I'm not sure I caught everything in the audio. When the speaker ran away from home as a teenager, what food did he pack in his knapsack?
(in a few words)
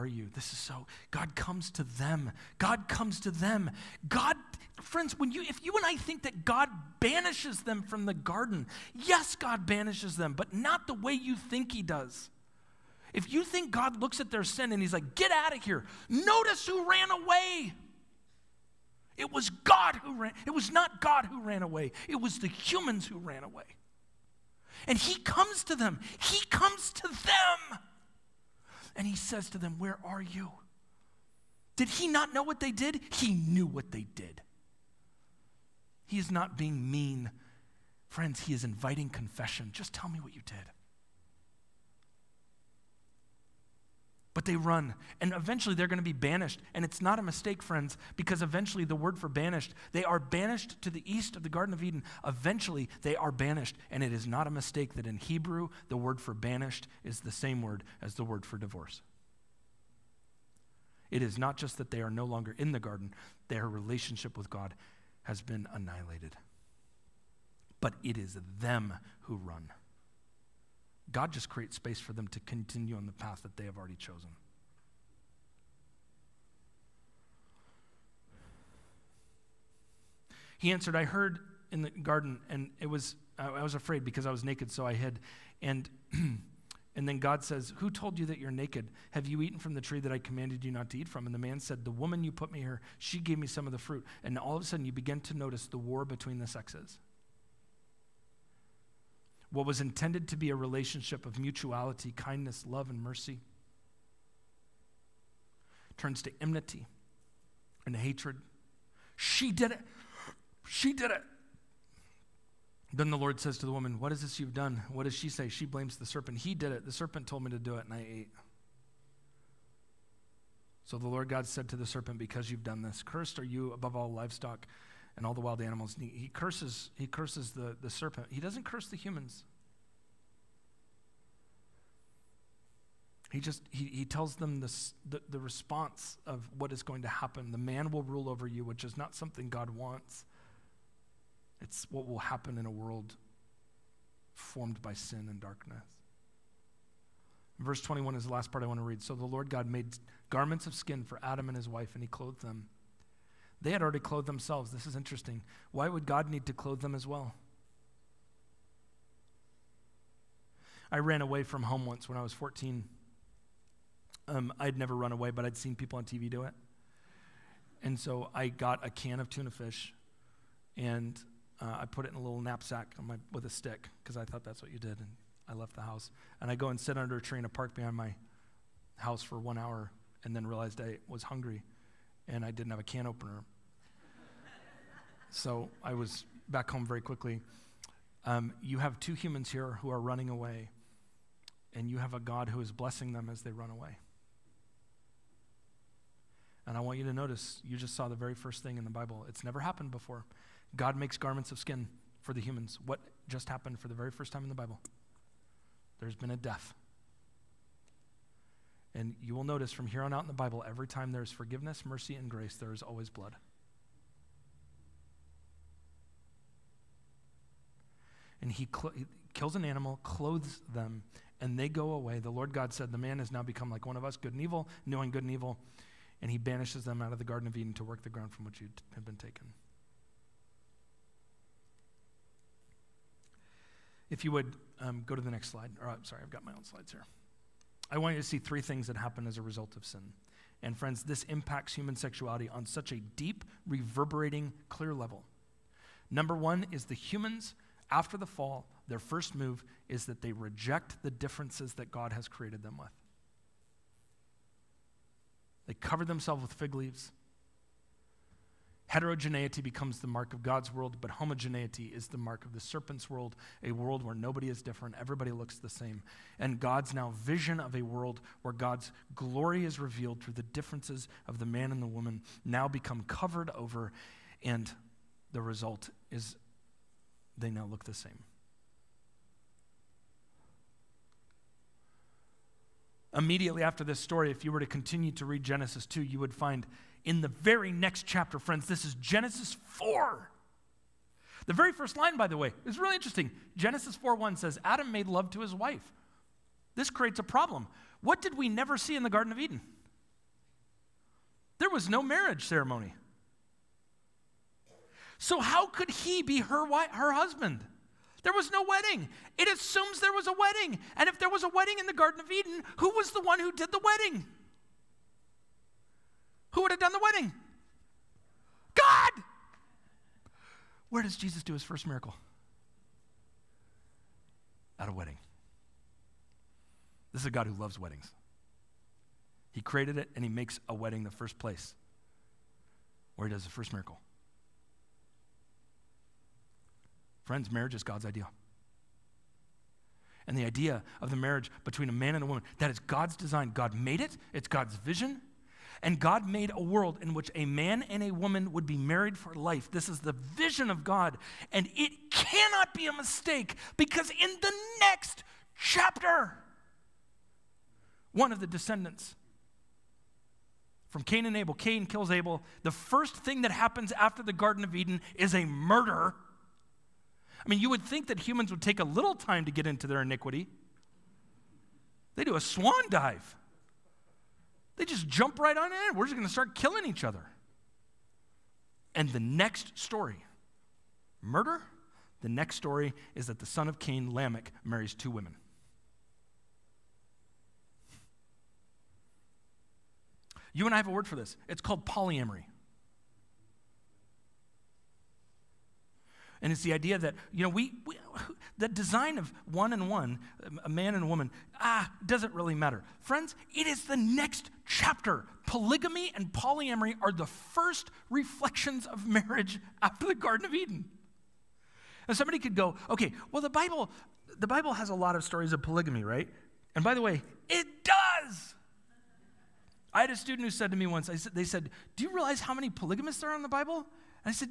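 tuna fish.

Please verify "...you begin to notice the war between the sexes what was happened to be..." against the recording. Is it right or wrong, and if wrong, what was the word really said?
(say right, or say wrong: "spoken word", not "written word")
wrong: "intended", not "happened".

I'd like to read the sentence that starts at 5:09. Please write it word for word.
It assumes there was a wedding.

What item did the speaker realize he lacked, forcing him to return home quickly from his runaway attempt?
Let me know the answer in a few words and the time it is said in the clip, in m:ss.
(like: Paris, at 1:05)
can opener, at 3:02.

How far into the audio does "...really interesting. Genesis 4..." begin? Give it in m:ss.
4:52.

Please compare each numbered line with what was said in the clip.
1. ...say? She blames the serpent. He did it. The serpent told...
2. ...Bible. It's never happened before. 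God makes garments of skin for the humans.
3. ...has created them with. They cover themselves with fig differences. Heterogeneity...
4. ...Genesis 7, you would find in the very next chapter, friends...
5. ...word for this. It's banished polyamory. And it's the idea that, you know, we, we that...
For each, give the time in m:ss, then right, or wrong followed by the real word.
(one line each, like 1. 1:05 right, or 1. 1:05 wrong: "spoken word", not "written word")
1. 1:55 right
2. 3:18 right
3. 4:12 wrong: "leaves", not "differences"
4. 4:45 wrong: "2", not "7"
5. 6:30 wrong: "called", not "banished".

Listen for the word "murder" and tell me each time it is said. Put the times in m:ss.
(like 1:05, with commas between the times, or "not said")
6:05, 6:21.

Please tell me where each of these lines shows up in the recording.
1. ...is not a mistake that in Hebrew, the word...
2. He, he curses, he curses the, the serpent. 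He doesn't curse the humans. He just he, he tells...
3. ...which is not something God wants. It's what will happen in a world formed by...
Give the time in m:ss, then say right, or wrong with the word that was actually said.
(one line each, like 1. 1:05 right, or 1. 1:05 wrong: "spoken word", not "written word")
1. 0:54 right
2. 2:05 right
3. 2:18 right.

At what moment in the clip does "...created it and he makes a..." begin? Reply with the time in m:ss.
5:29.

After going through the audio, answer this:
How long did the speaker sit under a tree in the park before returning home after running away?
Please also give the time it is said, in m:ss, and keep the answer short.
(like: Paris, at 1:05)
one hour, at 2:59.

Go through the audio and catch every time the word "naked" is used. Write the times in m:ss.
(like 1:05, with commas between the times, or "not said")
1:24, 1:28.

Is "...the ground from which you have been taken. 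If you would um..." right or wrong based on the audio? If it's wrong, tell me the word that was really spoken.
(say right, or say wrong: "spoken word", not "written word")
right.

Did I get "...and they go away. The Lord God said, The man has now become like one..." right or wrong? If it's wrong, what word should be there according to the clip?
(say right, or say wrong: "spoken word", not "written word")
right.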